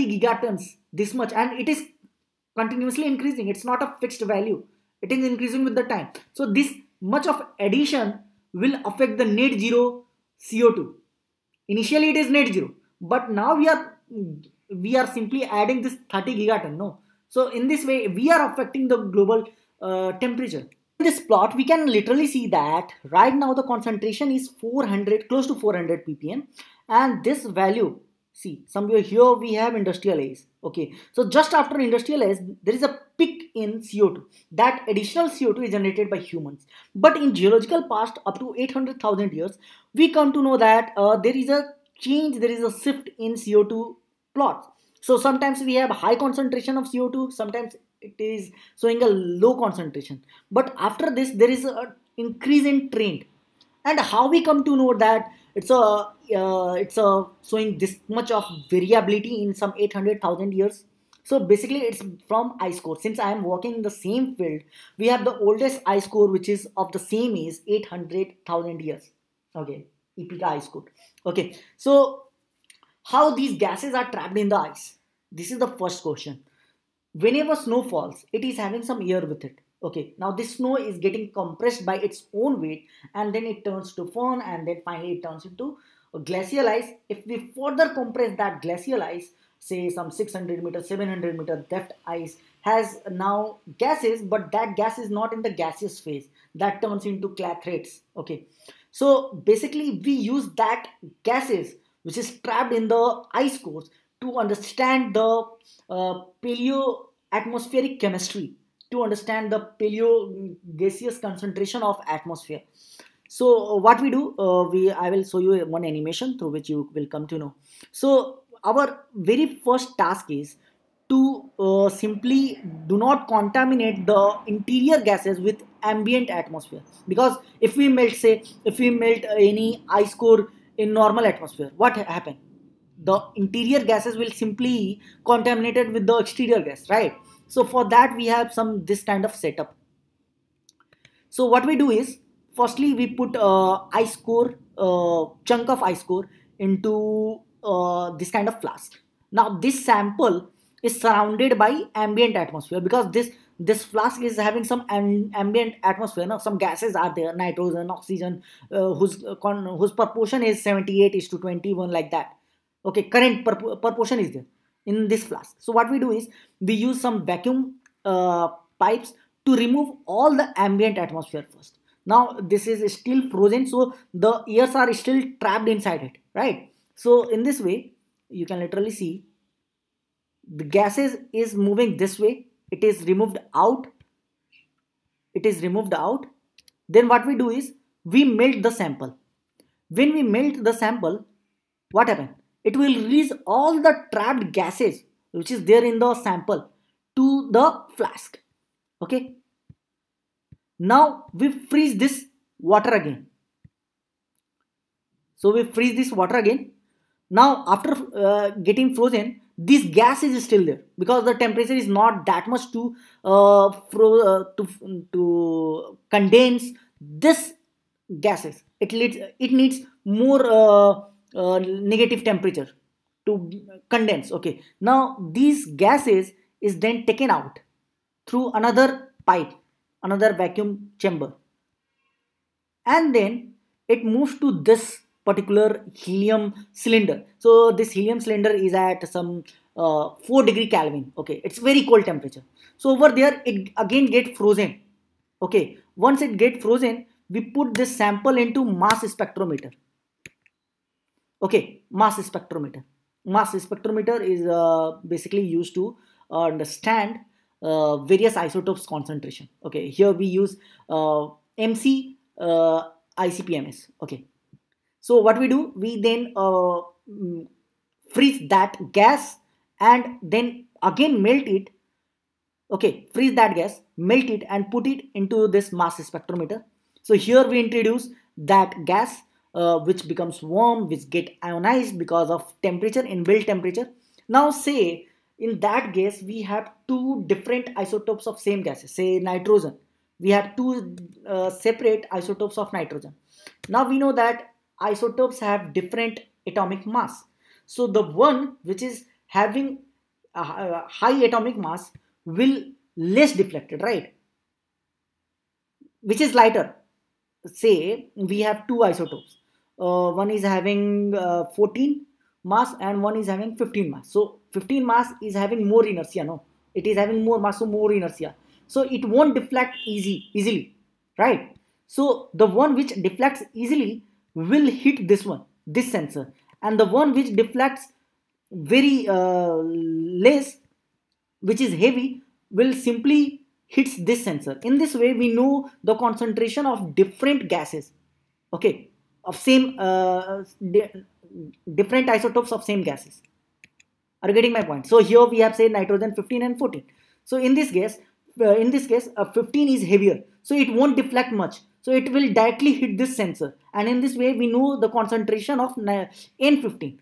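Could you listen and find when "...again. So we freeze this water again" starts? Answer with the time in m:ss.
3:22.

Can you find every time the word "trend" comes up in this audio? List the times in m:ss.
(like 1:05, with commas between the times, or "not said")
0:52.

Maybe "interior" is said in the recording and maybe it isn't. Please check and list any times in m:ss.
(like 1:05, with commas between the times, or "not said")
2:04, 2:13.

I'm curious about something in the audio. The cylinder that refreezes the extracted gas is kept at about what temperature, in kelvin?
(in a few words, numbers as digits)
4 K.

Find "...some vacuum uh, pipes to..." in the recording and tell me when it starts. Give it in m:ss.
2:47.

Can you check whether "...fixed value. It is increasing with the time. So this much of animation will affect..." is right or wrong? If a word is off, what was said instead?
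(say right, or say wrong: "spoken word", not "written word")
wrong: "addition", not "animation".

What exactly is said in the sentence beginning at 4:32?
Okay, freeze that gas, melt it and put it into this mass spectrometer.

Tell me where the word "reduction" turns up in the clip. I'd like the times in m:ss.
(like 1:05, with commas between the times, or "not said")
not said.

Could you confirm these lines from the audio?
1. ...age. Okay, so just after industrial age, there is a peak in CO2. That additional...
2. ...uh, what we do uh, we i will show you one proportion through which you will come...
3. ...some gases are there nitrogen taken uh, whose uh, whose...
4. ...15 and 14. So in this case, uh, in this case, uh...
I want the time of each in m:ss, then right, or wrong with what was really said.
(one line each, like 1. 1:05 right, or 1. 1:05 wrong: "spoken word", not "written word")
1. 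0:30 right
2. 1:53 wrong: "animation", not "proportion"
3. 2:36 wrong: "oxygen", not "taken"
4. 5:46 right.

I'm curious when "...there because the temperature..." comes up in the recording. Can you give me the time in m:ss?
3:30.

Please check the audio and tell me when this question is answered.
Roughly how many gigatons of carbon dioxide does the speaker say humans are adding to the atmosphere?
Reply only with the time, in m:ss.
0:16.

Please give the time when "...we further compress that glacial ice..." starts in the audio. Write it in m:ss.
1:27.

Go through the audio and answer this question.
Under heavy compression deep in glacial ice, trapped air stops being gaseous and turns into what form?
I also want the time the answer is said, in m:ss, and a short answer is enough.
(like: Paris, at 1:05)
clathrates, at 1:37.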